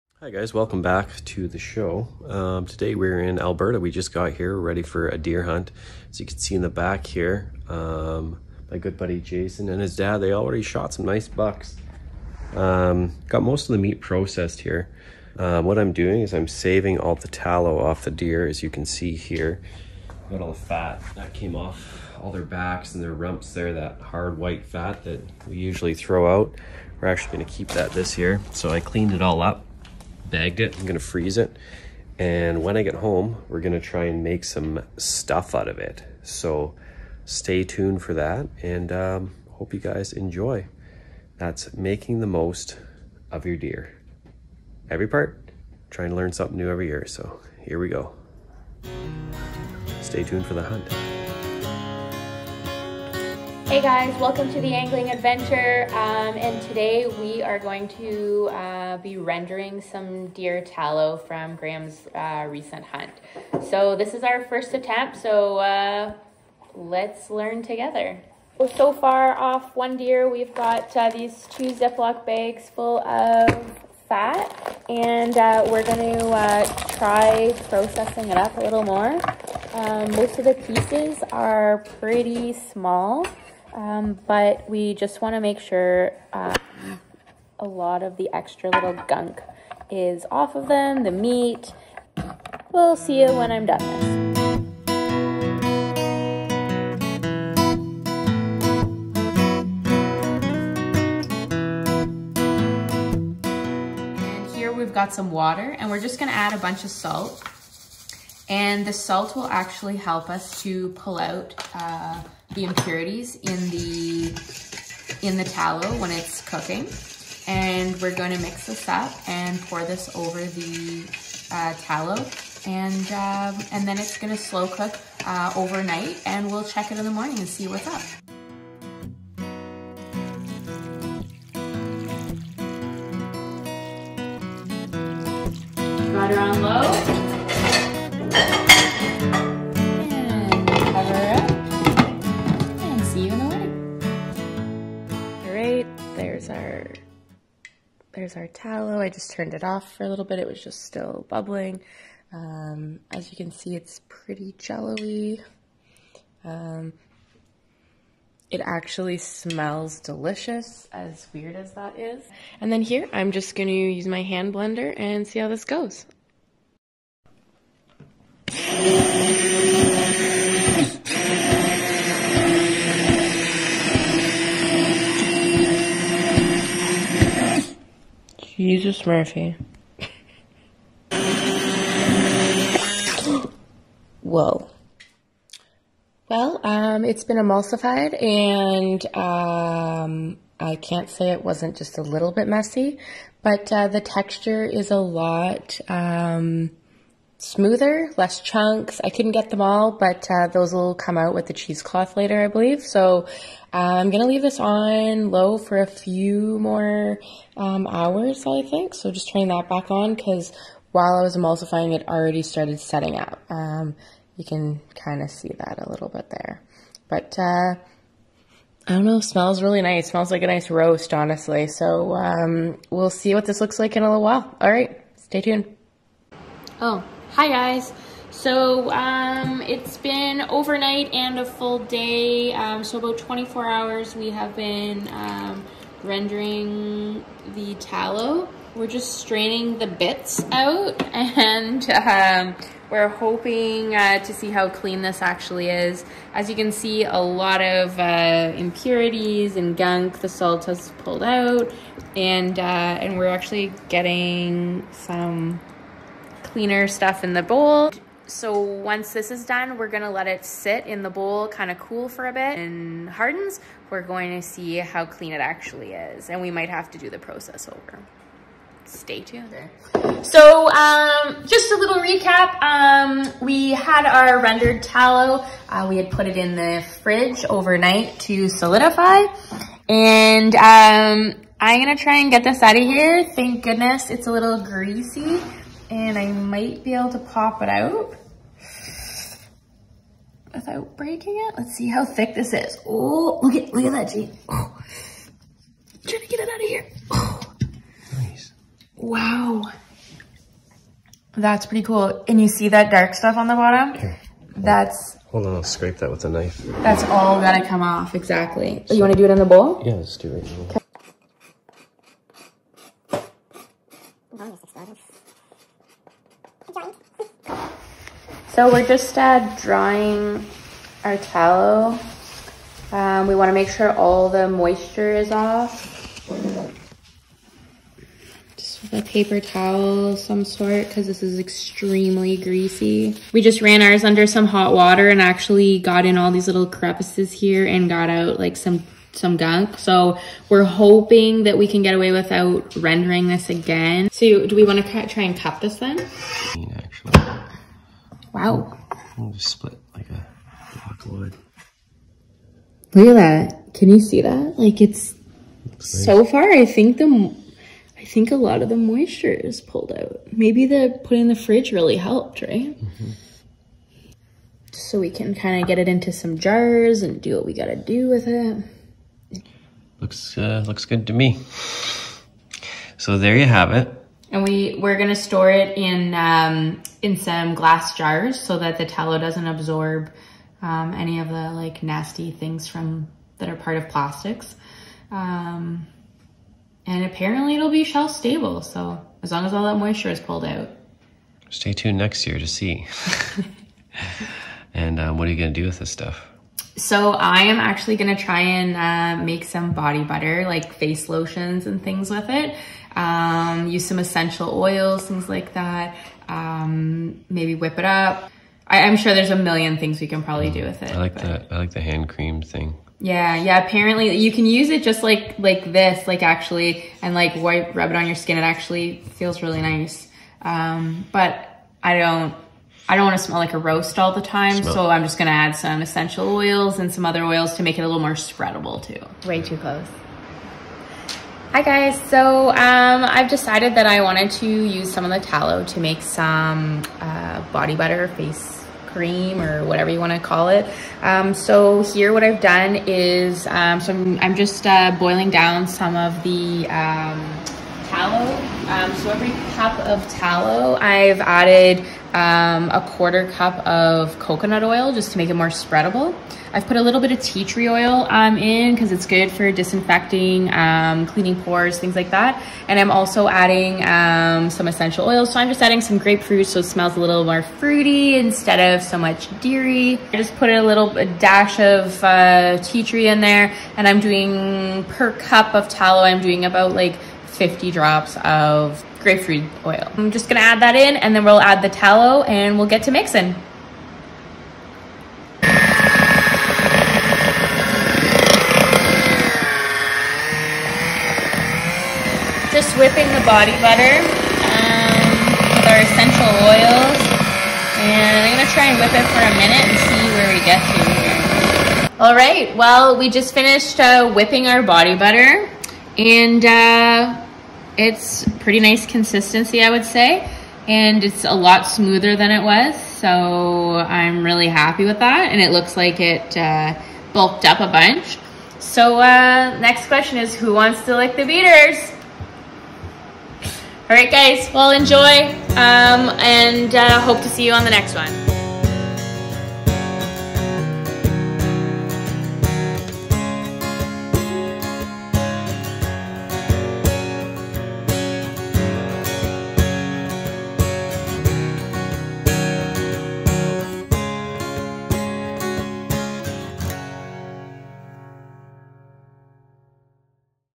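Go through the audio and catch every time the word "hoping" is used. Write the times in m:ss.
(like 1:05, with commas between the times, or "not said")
4:03, 5:40.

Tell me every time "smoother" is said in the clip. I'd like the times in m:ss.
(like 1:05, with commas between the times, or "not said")
3:17, 8:31.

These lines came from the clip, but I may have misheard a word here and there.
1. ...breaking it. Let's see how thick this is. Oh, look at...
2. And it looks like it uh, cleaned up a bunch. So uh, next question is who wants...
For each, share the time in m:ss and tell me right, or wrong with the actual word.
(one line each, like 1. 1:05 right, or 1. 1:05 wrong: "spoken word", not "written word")
1. 4:50 right
2. 8:35 wrong: "bulked", not "cleaned".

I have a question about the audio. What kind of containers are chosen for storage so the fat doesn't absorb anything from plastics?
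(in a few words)
Glass jars.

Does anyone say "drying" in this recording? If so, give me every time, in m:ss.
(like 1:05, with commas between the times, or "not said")
5:19.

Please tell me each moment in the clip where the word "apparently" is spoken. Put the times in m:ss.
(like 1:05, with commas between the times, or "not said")
6:27, 6:53.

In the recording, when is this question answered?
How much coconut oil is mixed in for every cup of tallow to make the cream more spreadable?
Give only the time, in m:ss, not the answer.
7:32.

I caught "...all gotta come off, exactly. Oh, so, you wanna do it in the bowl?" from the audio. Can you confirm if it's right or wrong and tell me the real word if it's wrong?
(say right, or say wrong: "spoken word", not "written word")
right.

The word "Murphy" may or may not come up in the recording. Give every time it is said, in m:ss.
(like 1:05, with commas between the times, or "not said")
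2:59.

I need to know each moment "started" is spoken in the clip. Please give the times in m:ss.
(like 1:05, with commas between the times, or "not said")
3:32.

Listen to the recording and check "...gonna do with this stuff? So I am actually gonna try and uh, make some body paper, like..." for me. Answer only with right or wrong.
wrong.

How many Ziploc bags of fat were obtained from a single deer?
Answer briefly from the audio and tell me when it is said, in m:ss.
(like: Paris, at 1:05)
2, at 1:11.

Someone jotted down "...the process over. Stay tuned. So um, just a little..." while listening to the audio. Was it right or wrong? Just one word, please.
right.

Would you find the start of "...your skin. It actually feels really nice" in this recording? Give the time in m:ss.
6:58.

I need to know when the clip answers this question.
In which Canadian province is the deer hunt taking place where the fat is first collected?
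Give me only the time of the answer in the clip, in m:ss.
0:03.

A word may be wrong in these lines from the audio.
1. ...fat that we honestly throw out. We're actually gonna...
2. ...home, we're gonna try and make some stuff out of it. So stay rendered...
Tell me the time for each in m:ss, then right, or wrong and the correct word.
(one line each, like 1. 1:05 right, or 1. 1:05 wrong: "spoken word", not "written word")
1. 0:24 wrong: "usually", not "honestly"
2. 0:32 wrong: "tuned", not "rendered".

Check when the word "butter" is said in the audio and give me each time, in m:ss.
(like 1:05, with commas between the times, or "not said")
6:40, 7:17, 8:13, 8:24.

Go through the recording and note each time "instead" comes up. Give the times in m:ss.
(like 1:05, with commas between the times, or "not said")
7:48.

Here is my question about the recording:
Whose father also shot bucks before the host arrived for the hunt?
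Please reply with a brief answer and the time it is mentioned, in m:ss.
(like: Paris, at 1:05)
Jason, at 0:09.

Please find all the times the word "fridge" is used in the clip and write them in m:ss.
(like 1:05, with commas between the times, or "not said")
4:37, 6:01.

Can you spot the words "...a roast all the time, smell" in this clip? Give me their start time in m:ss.
7:03.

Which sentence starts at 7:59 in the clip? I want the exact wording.
I'm just gonna add that in and then we'll add the tallow and we'll get to mixing.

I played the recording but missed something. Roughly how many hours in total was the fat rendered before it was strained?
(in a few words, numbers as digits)
24.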